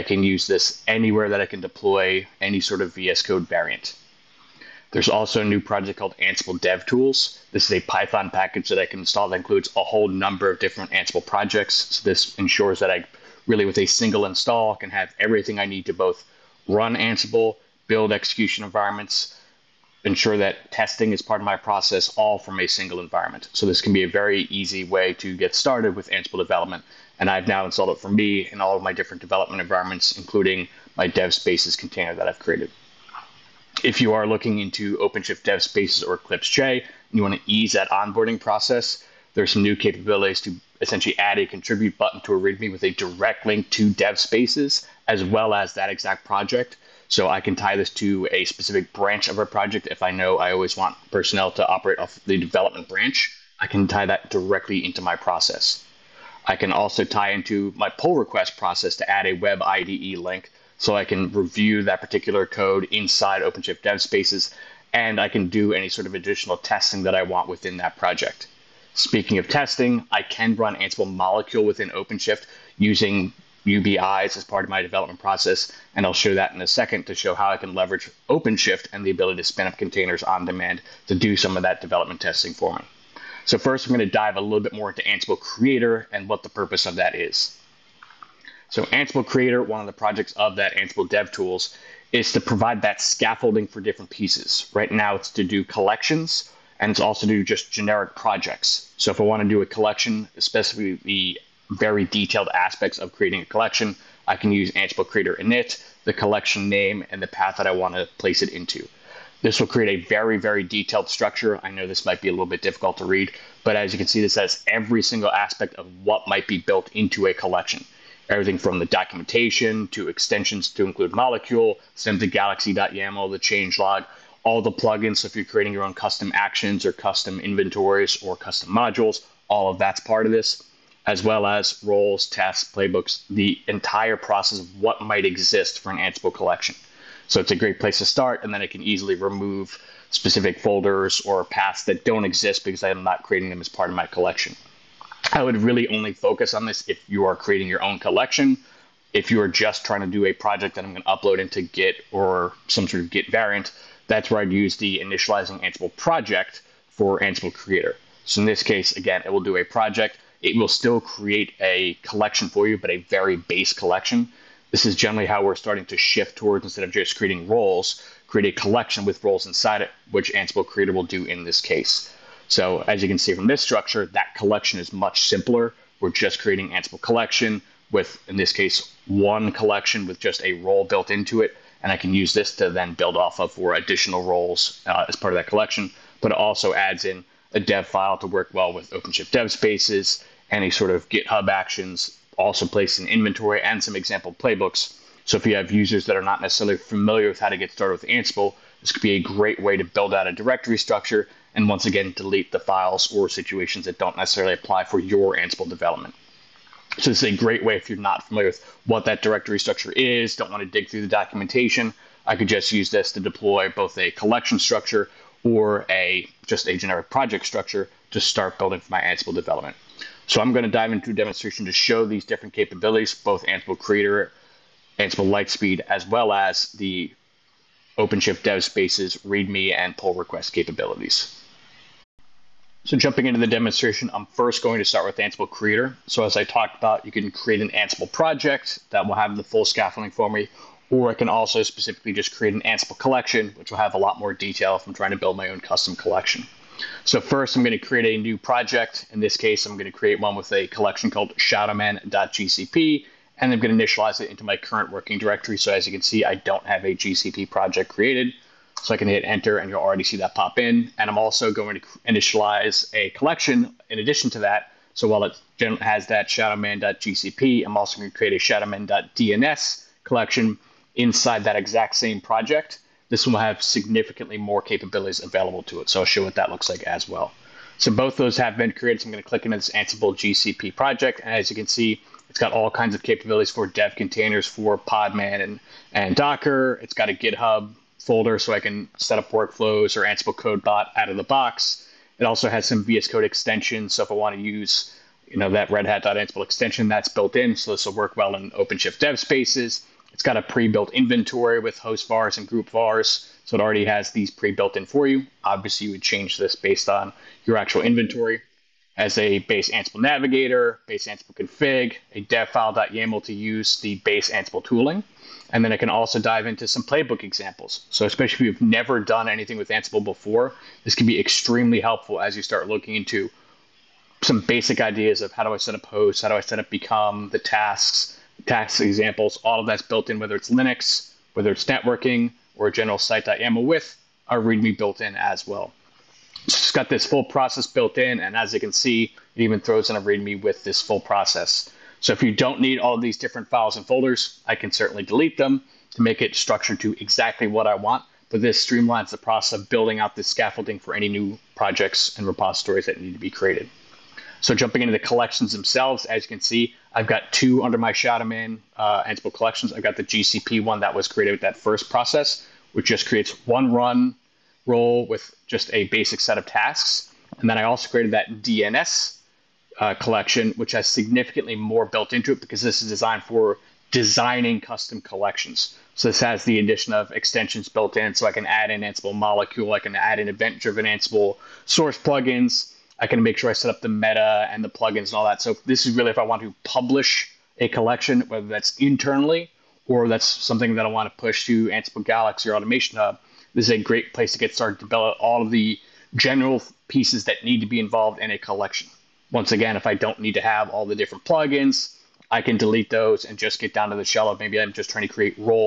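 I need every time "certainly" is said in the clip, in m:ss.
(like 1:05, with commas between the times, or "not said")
5:44.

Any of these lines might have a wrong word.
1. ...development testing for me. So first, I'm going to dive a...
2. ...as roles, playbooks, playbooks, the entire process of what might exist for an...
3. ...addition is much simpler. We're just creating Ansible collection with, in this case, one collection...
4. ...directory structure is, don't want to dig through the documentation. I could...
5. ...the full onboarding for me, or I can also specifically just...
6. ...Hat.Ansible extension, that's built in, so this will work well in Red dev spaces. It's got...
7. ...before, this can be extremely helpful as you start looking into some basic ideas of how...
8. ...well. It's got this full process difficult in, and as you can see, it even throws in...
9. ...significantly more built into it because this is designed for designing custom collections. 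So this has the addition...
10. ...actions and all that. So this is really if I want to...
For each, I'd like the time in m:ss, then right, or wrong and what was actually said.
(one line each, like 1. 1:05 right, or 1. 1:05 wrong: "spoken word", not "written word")
1. 1:21 right
2. 2:11 wrong: "tasks", not "playbooks"
3. 2:54 wrong: "collection", not "addition"
4. 3:29 right
5. 3:59 wrong: "scaffolding", not "onboarding"
6. 4:55 wrong: "OpenShift", not "Red"
7. 5:20 right
8. 5:35 wrong: "built", not "difficult"
9. 6:10 right
10. 6:24 wrong: "plugins", not "actions".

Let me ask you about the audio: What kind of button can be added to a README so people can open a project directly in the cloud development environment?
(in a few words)
contribute button.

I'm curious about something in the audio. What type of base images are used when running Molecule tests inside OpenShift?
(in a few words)
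UBIs.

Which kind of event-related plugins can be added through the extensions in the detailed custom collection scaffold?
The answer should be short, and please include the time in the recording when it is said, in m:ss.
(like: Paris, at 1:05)
event-driven Ansible source plugins, at 6:20.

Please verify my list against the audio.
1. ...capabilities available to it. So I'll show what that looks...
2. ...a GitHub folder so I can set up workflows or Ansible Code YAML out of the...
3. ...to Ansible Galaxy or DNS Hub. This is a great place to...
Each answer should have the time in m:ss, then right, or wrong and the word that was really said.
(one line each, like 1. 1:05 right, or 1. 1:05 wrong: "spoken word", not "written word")
1. 4:34 right
2. 4:47 wrong: "Bot", not "YAML"
3. 6:31 wrong: "Automation", not "DNS".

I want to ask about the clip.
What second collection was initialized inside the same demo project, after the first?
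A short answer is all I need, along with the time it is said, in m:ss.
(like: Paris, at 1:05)
shadowman.dns, at 4:28.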